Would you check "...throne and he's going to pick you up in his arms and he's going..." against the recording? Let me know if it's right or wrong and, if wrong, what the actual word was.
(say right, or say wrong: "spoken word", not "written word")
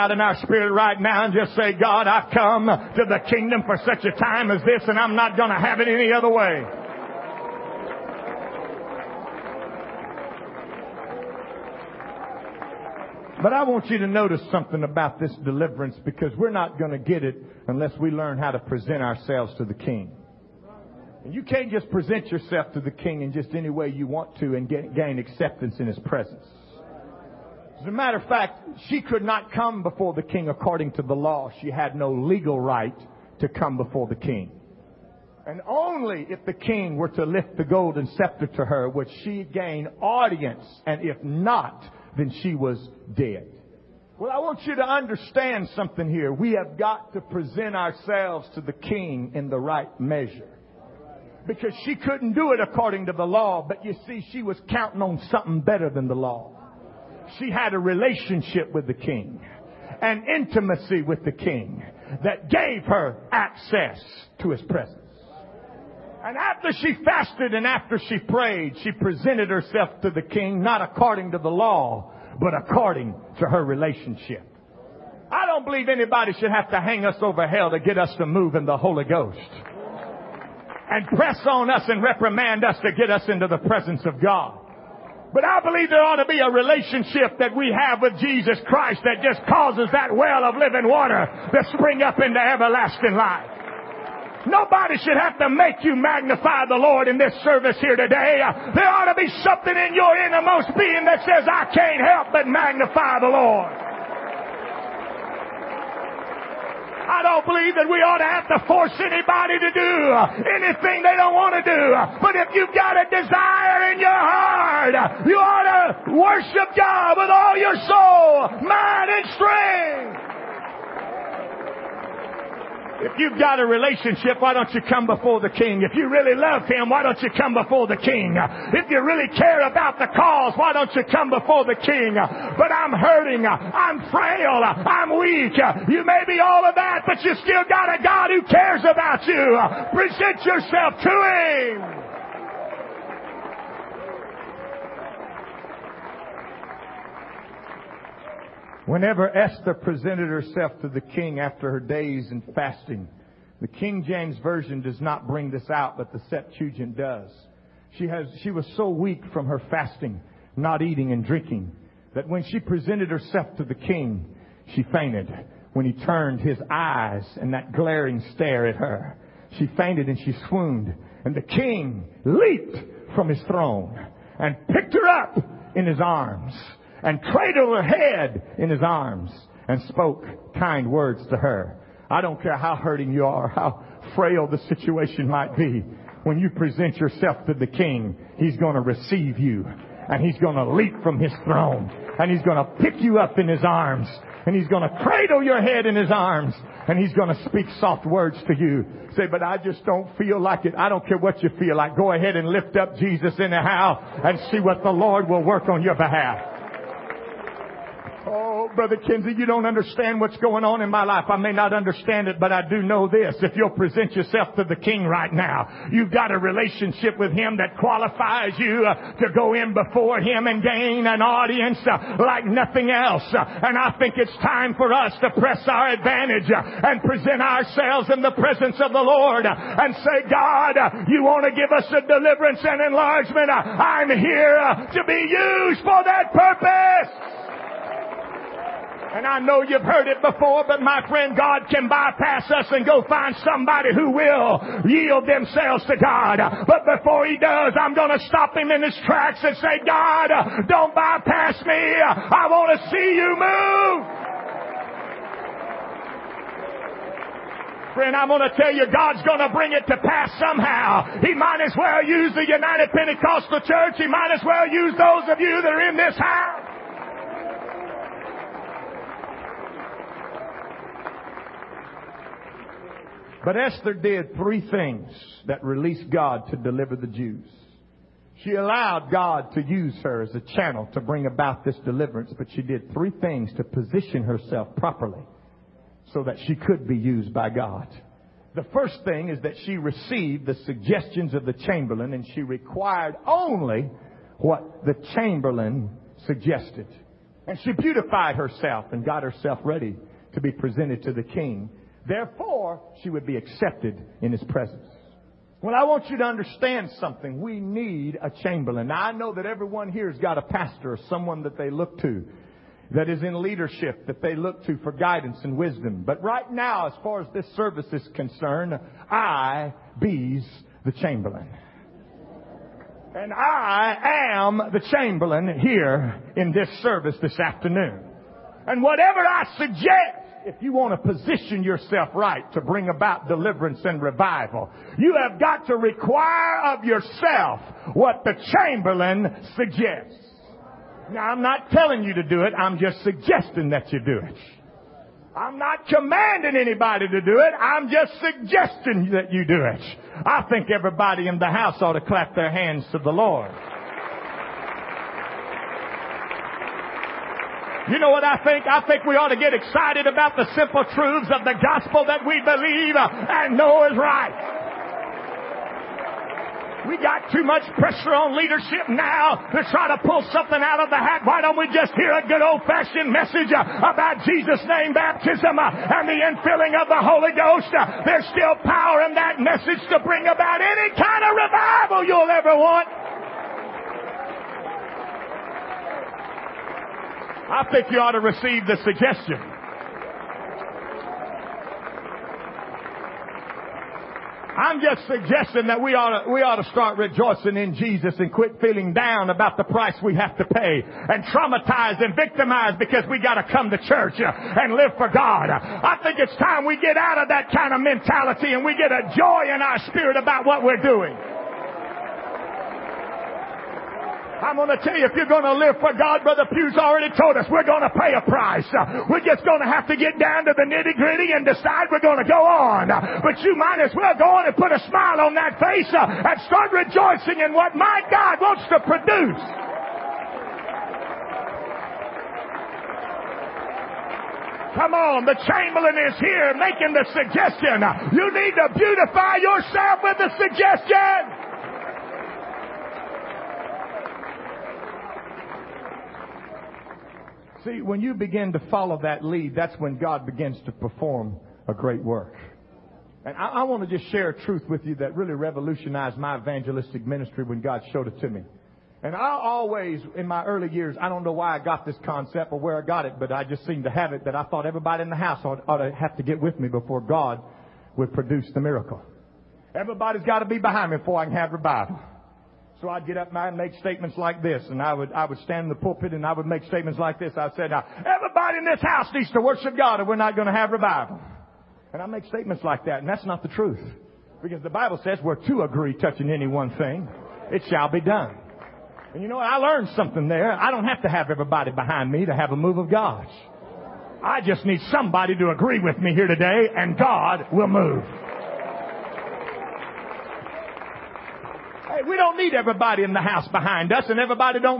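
right.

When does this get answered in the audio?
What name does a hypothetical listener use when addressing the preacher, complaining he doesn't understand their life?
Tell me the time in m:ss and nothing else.
3:28.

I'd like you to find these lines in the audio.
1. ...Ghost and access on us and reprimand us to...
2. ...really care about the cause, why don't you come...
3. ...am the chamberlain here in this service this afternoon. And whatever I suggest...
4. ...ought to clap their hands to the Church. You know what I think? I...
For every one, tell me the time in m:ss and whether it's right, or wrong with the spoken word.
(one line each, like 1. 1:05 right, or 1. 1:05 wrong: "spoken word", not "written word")
1. 1:19 wrong: "press", not "access"
2. 2:09 right
3. 5:24 right
4. 5:51 wrong: "Lord", not "Church".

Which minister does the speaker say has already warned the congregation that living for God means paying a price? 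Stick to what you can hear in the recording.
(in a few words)
Brother Pugh.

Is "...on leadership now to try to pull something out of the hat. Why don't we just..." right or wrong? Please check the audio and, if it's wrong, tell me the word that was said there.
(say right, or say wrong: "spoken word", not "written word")
right.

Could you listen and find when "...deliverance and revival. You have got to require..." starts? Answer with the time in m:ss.
5:33.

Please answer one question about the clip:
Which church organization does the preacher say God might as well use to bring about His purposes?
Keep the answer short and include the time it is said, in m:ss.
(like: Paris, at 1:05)
United Pentecostal Church, at 4:22.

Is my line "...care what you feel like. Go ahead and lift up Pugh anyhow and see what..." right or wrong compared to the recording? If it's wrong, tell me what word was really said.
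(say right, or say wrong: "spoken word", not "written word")
wrong: "Jesus", not "Pugh".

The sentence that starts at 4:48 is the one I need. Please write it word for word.
The first thing is that she received the suggestions of the chamberlain and she required only what the chamberlain suggested.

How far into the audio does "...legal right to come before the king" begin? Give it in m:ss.
0:32.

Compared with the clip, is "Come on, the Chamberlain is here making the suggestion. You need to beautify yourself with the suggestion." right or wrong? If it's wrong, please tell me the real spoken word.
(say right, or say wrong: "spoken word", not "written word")
right.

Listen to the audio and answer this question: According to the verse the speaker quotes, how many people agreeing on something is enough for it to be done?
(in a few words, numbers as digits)
2.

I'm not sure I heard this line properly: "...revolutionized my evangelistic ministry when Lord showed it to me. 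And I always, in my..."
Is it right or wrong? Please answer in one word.
wrong.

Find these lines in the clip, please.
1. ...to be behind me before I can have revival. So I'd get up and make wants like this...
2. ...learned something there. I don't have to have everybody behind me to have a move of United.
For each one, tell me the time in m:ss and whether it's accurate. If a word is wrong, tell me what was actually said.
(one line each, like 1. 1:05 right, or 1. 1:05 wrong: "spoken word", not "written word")
1. 7:50 wrong: "statements", not "wants"
2. 8:09 wrong: "God", not "United".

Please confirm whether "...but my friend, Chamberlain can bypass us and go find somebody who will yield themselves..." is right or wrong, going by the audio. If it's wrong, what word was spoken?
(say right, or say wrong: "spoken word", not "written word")
wrong: "God", not "Chamberlain".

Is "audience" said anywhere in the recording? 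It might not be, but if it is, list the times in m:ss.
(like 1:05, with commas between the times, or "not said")
0:40, 3:41.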